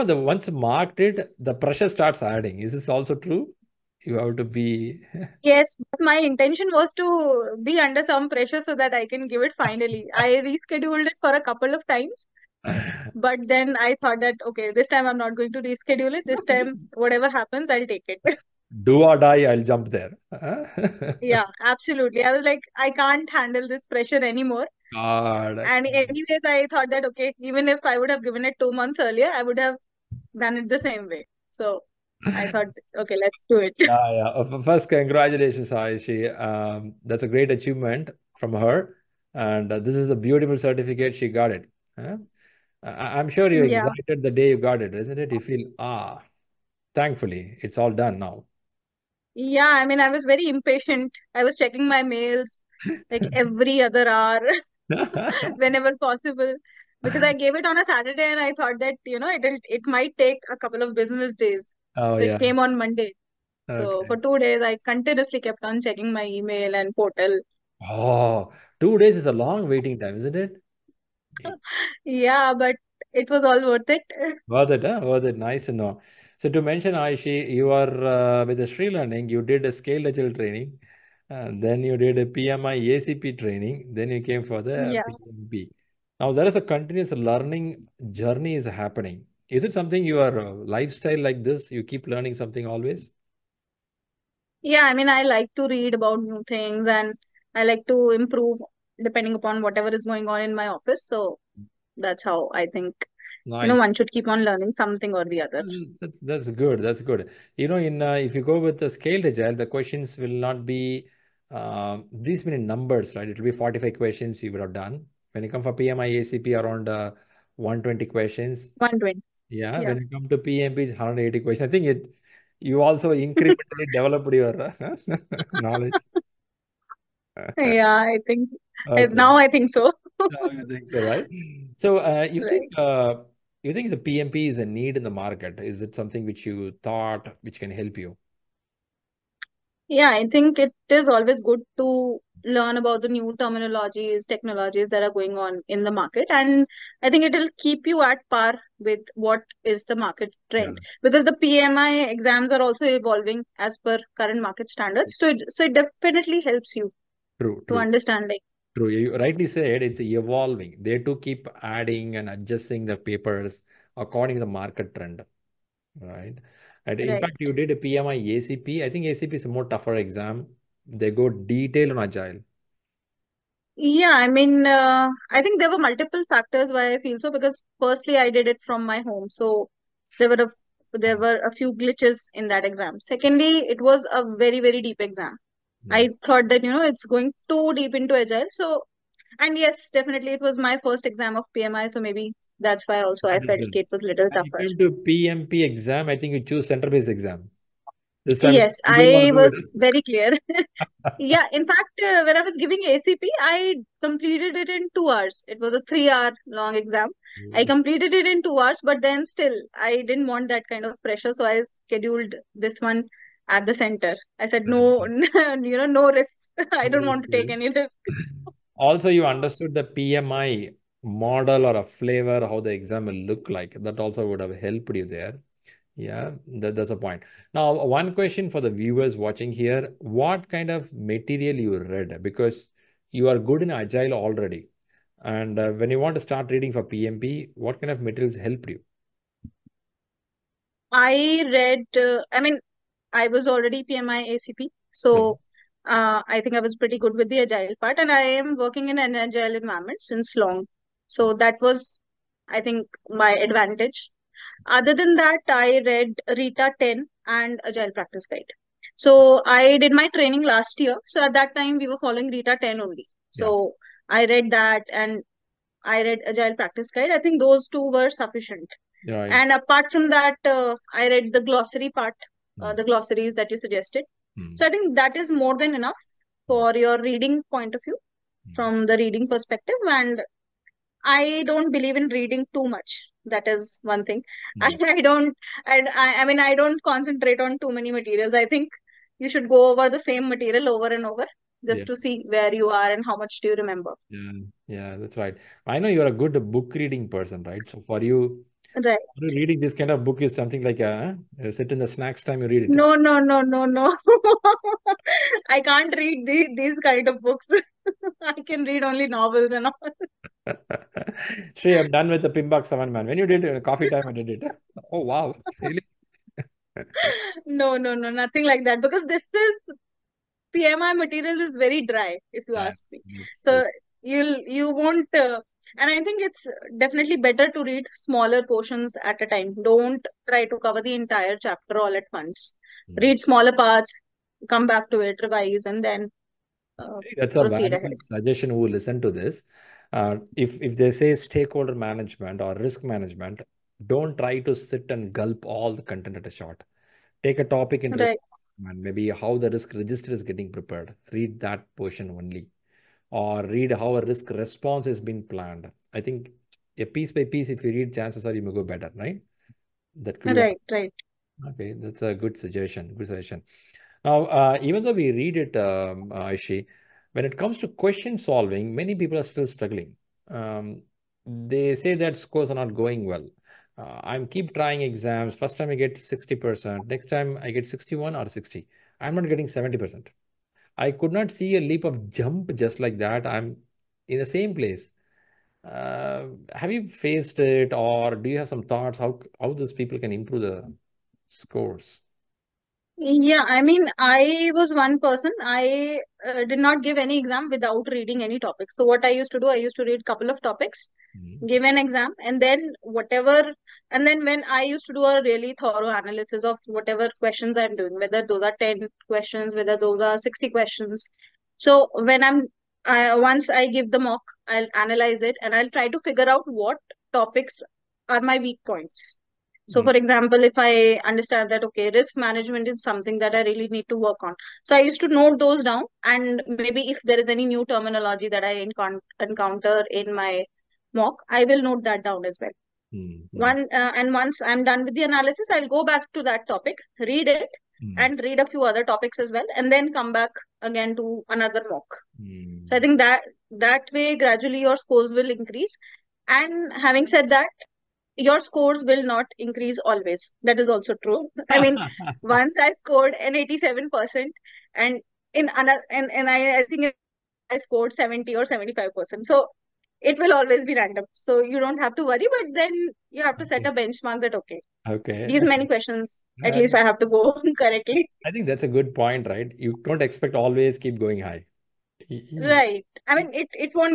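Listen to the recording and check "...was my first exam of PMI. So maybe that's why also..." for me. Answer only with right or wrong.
right.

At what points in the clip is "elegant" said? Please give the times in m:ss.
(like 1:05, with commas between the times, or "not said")
not said.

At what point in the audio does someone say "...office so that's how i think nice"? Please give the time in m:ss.
1:40.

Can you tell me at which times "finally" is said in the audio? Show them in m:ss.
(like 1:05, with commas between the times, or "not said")
0:09.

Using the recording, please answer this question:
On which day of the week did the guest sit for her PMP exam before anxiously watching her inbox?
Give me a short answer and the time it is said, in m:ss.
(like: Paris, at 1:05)
Saturday, at 0:57.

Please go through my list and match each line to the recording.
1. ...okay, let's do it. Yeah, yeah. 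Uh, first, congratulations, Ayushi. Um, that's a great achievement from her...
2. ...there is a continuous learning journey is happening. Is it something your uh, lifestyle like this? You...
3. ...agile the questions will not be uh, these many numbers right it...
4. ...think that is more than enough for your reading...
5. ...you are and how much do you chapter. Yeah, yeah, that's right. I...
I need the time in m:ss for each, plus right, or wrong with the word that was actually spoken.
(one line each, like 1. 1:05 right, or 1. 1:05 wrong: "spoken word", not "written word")
1. 0:32 right
2. 1:26 right
3. 1:49 right
4. 4:34 right
5. 4:52 wrong: "remember", not "chapter".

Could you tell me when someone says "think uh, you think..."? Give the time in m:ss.
2:12.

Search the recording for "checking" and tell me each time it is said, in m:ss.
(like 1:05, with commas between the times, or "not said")
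0:51, 1:05.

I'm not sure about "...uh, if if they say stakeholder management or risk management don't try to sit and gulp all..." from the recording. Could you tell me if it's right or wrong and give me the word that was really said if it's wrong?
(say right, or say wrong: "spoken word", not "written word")
right.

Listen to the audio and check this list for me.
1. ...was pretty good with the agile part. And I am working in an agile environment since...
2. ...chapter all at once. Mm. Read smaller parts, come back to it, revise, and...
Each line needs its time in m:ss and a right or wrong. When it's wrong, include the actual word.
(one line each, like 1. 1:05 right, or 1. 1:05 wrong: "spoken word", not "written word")
1. 4:06 right
2. 5:31 right.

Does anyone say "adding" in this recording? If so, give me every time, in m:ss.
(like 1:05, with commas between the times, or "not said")
0:02, 2:41.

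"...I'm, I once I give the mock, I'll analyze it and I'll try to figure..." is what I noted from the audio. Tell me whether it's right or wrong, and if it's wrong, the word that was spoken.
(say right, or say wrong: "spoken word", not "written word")
right.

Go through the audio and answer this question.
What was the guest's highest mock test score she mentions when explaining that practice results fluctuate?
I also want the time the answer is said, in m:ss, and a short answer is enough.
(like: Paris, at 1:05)
87%, at 7:33.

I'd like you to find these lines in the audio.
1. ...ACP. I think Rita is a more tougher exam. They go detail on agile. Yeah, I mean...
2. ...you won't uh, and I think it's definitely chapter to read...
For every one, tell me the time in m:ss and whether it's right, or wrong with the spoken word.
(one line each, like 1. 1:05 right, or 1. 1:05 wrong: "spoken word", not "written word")
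1. 2:48 wrong: "ACP", not "Rita"
2. 5:24 wrong: "better", not "chapter".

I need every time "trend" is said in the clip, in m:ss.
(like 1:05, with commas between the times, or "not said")
2:30, 2:44.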